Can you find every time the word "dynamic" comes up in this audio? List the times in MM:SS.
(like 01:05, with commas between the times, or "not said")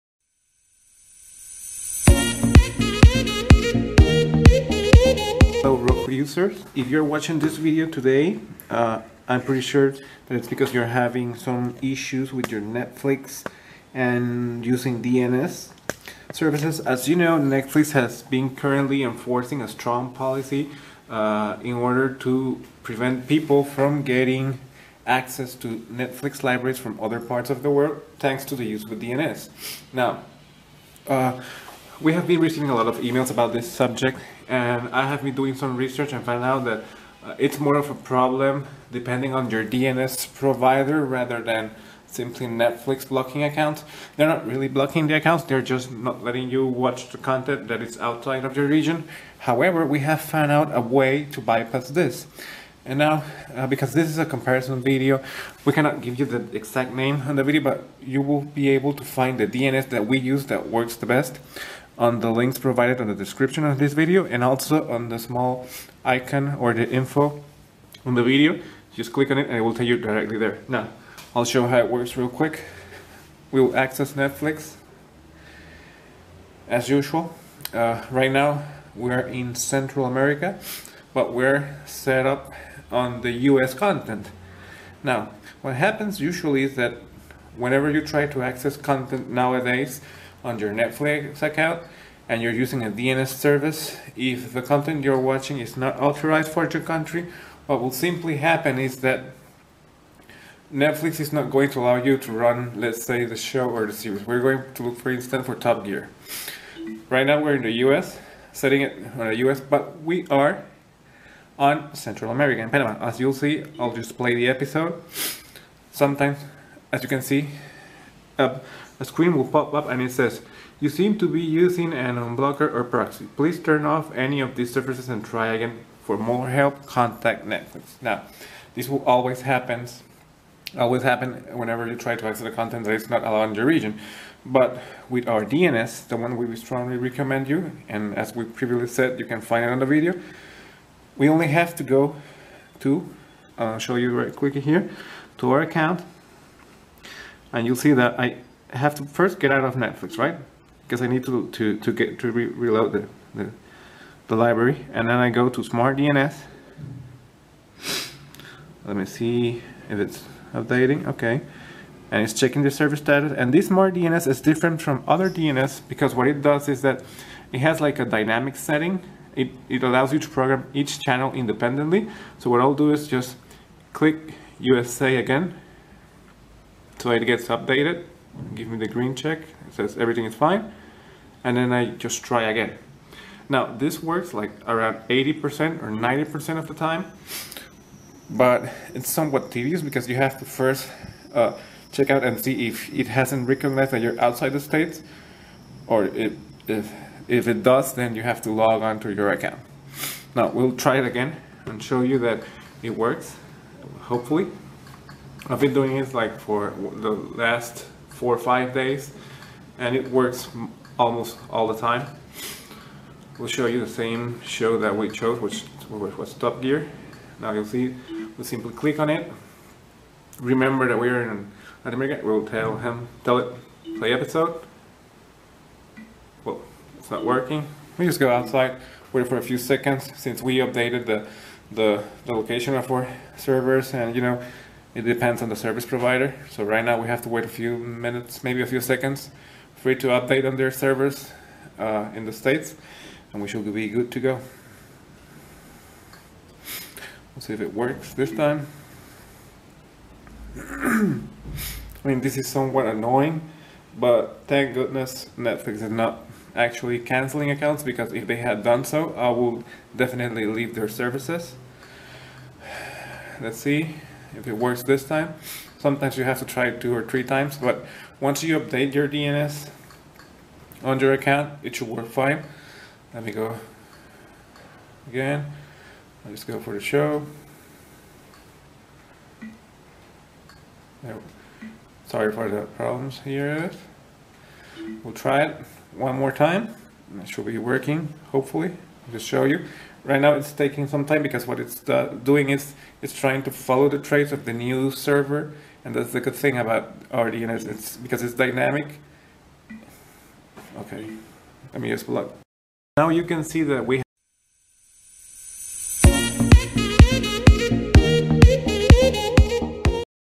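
02:48, 04:58.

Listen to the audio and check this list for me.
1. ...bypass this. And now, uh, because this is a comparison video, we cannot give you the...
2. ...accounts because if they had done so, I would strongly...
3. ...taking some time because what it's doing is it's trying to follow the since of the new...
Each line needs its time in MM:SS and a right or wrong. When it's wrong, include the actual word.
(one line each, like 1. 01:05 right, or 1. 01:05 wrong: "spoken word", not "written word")
1. 00:51 right
2. 04:17 wrong: "definitely", not "strongly"
3. 04:50 wrong: "trace", not "since".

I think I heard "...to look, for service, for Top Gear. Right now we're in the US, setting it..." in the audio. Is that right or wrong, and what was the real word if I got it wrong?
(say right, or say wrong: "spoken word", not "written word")
wrong: "instance", not "service".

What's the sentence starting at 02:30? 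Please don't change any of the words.
Because I need to, to, to get to re reload the, the, the library.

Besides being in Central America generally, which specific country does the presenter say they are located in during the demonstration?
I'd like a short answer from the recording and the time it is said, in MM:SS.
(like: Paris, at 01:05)
Panama, at 01:52.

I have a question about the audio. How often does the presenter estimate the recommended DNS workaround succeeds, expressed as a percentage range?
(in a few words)
80% or 90%.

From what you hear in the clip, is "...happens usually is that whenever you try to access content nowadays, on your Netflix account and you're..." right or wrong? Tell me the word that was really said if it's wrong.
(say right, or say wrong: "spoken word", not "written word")
right.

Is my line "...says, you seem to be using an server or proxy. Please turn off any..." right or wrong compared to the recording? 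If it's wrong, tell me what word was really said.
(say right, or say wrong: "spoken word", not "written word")
wrong: "unblocker", not "server".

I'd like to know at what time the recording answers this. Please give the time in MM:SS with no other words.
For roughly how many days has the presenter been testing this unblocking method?
03:28.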